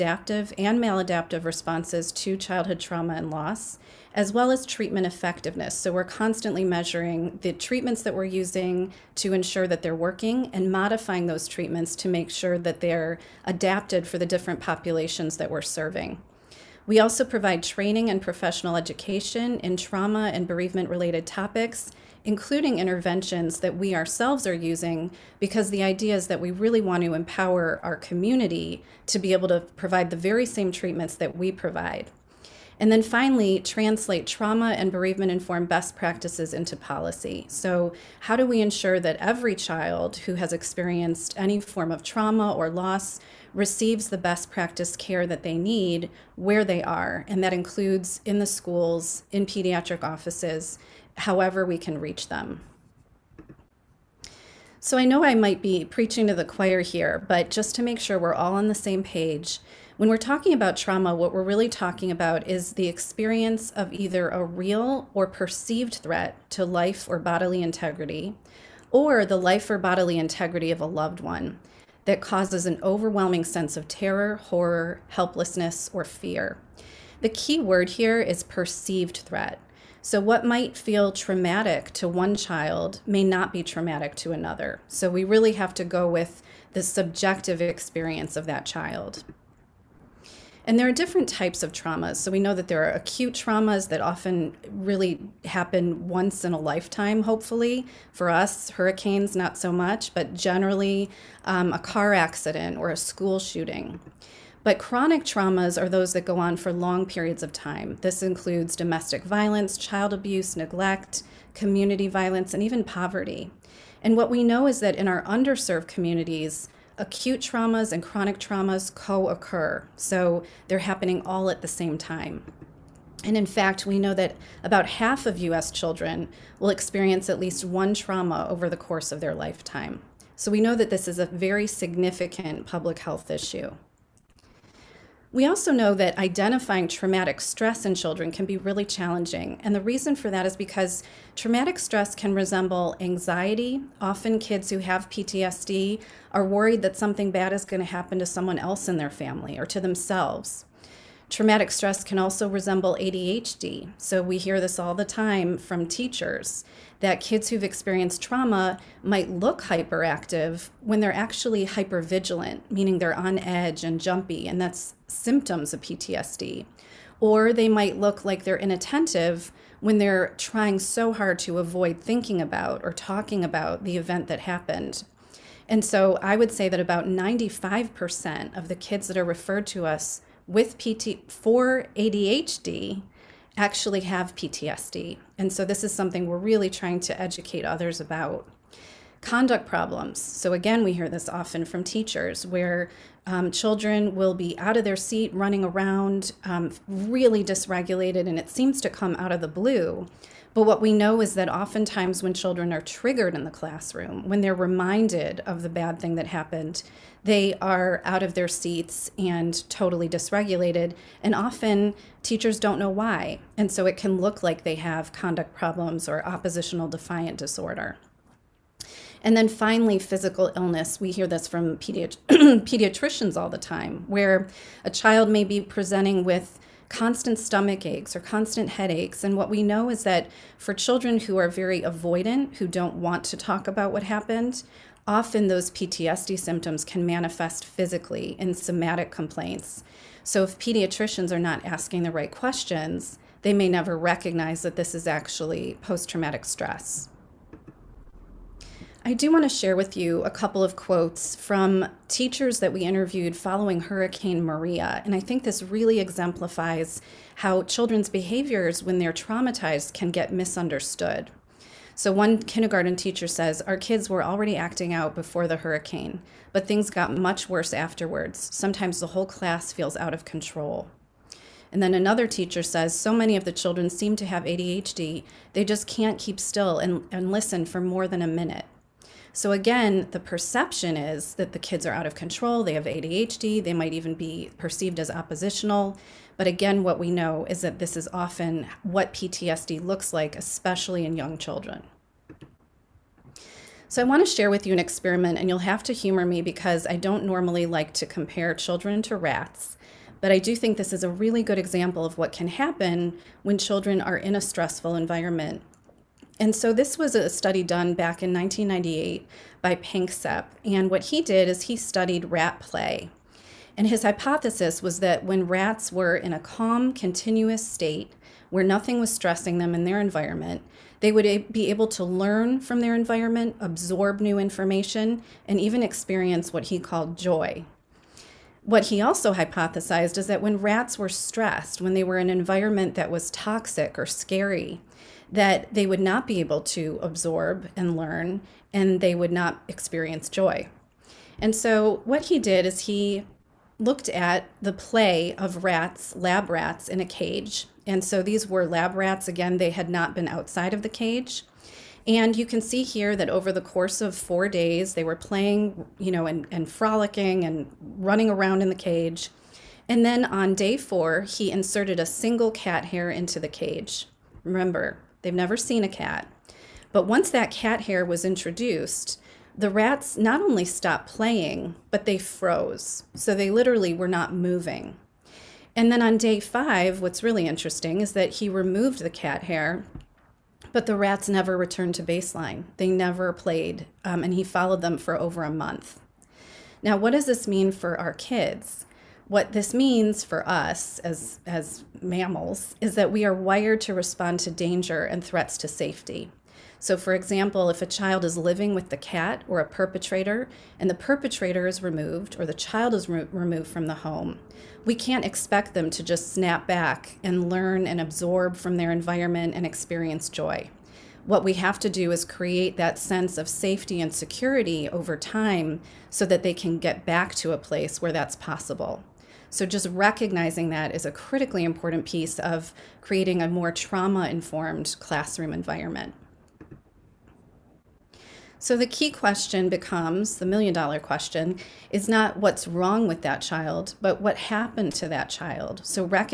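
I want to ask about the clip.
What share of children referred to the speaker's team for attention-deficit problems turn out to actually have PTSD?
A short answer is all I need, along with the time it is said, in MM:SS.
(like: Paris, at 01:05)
95%, at 02:57.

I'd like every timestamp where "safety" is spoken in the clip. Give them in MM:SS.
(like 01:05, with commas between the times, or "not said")
06:35, 06:53.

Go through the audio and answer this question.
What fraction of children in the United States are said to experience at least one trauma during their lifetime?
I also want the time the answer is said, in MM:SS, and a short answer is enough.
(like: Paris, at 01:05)
half, at 02:04.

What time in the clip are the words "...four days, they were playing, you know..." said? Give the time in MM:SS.
05:54.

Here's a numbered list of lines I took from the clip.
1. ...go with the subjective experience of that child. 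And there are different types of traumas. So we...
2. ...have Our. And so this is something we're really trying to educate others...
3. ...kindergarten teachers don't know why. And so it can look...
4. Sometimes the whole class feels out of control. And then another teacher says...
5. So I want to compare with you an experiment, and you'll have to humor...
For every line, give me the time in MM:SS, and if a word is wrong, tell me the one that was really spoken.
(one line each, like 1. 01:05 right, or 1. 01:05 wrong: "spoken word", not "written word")
1. 01:25 right
2. 03:04 wrong: "PTSD", not "Our"
3. 03:31 wrong: "often", not "kindergarten"
4. 04:28 right
5. 04:53 wrong: "share", not "compare".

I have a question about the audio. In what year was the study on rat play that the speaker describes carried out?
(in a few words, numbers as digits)
1998.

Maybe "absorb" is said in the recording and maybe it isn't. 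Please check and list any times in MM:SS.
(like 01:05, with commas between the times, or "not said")
05:23, 05:37, 06:48.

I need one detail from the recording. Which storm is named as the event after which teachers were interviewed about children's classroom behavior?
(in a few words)
Hurricane Maria.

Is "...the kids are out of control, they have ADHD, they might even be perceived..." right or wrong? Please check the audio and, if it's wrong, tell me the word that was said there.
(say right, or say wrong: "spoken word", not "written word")
right.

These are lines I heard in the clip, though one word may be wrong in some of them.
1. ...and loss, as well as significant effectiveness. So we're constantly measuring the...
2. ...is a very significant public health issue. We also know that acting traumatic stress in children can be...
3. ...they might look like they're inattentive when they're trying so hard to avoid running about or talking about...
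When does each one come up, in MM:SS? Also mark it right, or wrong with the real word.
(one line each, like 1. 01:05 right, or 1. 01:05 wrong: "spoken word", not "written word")
1. 00:03 wrong: "treatment", not "significant"
2. 02:11 wrong: "identifying", not "acting"
3. 02:47 wrong: "thinking", not "running".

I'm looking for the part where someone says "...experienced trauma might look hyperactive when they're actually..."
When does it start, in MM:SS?
02:37.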